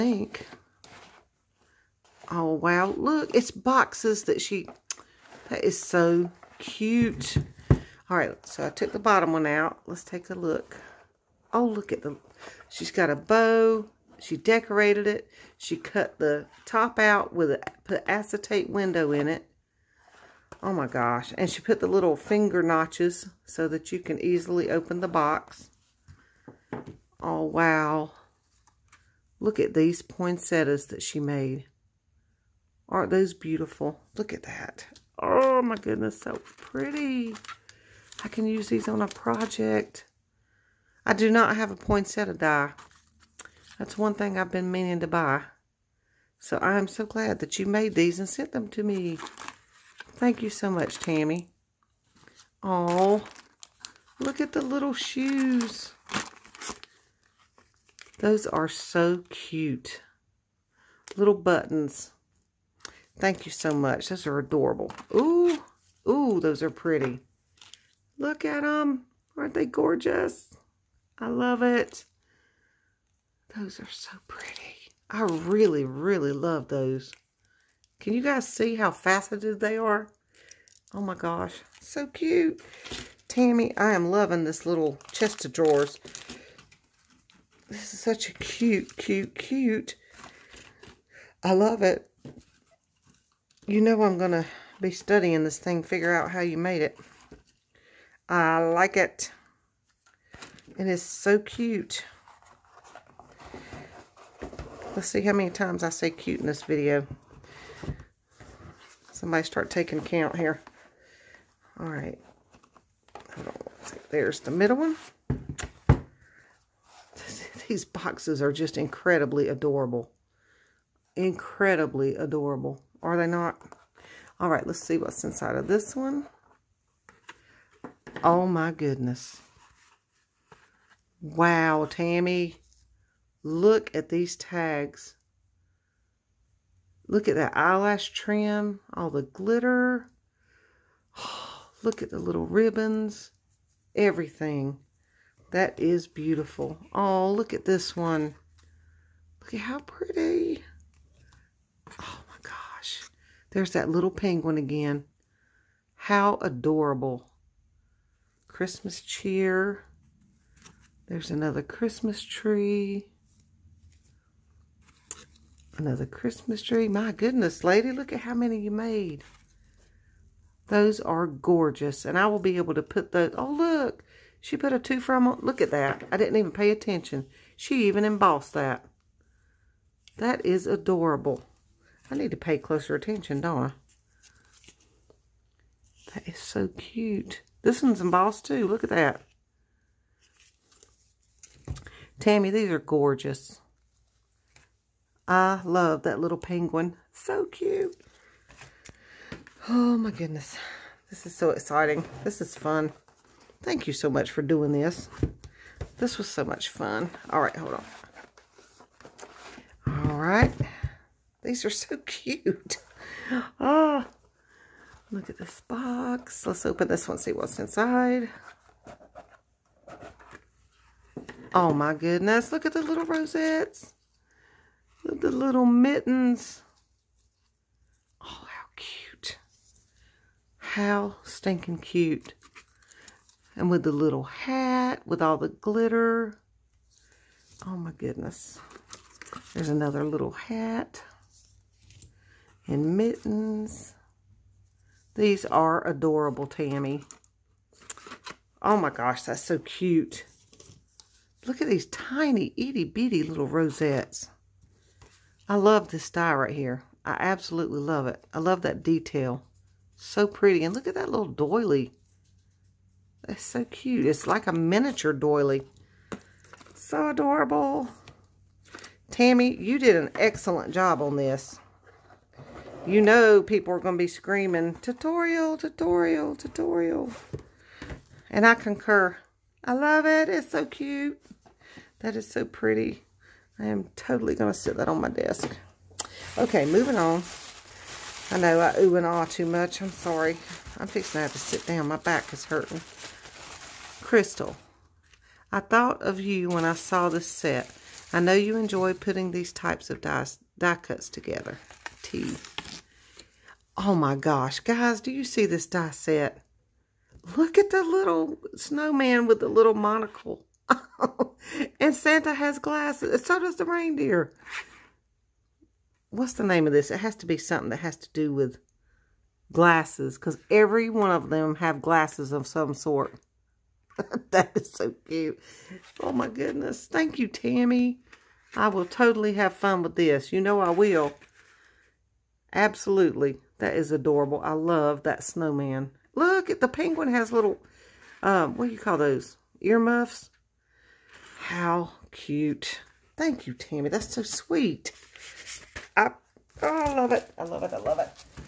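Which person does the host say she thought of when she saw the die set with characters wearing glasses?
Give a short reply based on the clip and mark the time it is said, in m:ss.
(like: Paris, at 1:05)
Crystal, at 4:54.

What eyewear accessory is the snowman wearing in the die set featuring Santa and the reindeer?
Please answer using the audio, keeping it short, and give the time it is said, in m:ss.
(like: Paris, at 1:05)
Monocle, at 5:09.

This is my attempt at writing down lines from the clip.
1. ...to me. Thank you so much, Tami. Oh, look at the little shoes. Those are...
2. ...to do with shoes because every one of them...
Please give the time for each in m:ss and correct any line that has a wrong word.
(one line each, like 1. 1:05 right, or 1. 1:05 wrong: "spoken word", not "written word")
1. 0:48 right
2. 5:17 wrong: "glasses", not "shoes".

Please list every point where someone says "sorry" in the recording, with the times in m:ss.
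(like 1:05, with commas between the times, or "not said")
4:49.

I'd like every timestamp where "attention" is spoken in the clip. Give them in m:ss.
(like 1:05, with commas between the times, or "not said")
2:56, 3:02.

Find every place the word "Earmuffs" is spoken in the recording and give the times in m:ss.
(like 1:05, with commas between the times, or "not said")
5:39.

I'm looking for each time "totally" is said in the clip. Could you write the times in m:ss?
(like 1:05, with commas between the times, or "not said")
4:43, 5:28.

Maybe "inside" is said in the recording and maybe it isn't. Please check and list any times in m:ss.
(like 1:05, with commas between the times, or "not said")
2:05, 3:37.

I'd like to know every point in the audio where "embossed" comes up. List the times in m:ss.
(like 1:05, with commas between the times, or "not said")
2:58, 3:08.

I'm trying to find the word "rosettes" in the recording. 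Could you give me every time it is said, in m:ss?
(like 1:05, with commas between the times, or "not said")
3:43, 4:13.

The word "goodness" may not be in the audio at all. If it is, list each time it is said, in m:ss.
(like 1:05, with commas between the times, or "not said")
0:35, 2:08, 2:47, 3:20, 3:41, 3:57, 5:26.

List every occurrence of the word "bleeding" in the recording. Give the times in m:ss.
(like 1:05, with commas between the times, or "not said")
not said.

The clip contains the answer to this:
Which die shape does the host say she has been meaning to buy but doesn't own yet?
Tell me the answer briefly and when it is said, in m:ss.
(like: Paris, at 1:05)
Poinsettia die, at 0:41.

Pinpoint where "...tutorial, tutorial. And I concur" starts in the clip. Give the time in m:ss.
4:35.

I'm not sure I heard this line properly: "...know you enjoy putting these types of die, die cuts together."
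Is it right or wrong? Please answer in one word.
right.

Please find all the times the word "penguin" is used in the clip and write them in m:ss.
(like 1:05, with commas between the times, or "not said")
2:34, 3:16, 5:36.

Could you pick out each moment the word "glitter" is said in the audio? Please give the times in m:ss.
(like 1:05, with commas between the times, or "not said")
2:19, 3:55.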